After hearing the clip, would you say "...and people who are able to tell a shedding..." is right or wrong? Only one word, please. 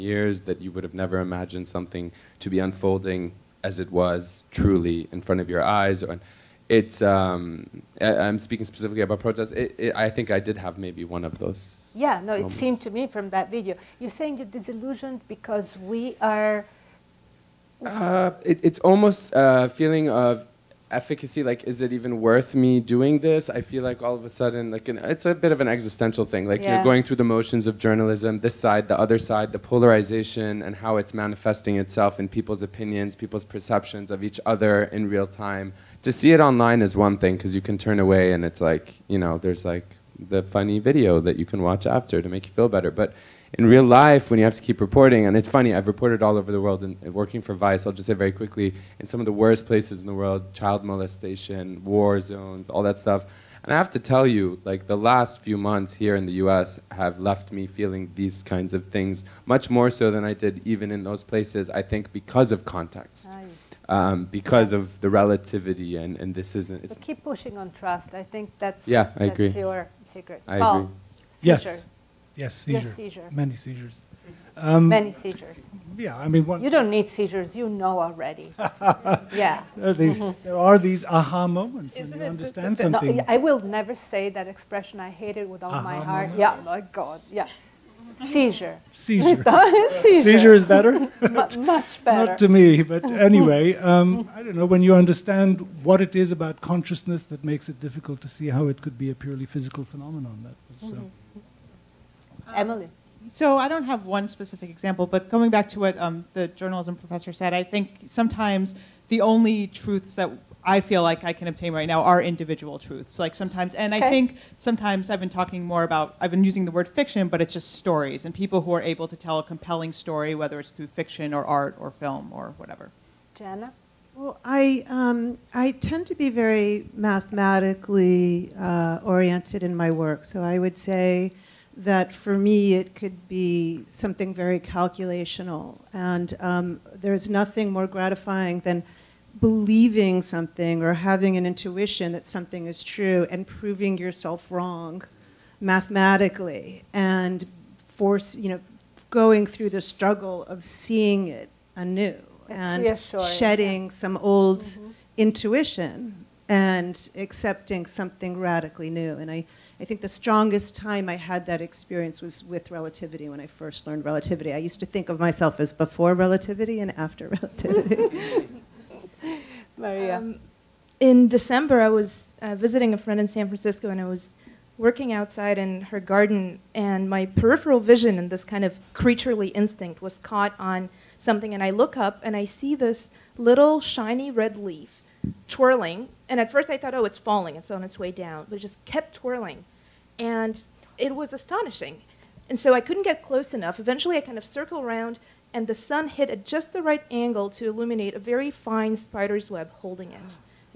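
wrong.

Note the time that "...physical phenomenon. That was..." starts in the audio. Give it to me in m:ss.
1:39.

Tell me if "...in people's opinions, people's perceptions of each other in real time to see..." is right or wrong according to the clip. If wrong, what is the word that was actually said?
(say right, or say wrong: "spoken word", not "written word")
right.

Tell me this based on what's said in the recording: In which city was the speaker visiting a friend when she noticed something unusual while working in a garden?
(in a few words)
San Francisco.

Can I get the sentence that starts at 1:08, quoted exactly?
I think that's, yeah, I that's agree.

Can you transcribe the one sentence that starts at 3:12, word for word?
And so I couldn't get close enough.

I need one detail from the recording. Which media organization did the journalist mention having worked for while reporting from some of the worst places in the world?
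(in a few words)
Vice.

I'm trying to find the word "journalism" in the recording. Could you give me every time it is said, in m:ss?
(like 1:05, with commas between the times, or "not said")
0:27, 1:46.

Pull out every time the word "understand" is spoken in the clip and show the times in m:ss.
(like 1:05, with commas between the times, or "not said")
1:22, 1:34.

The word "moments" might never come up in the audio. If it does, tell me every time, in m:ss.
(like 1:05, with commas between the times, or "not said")
0:12, 1:21, 1:26.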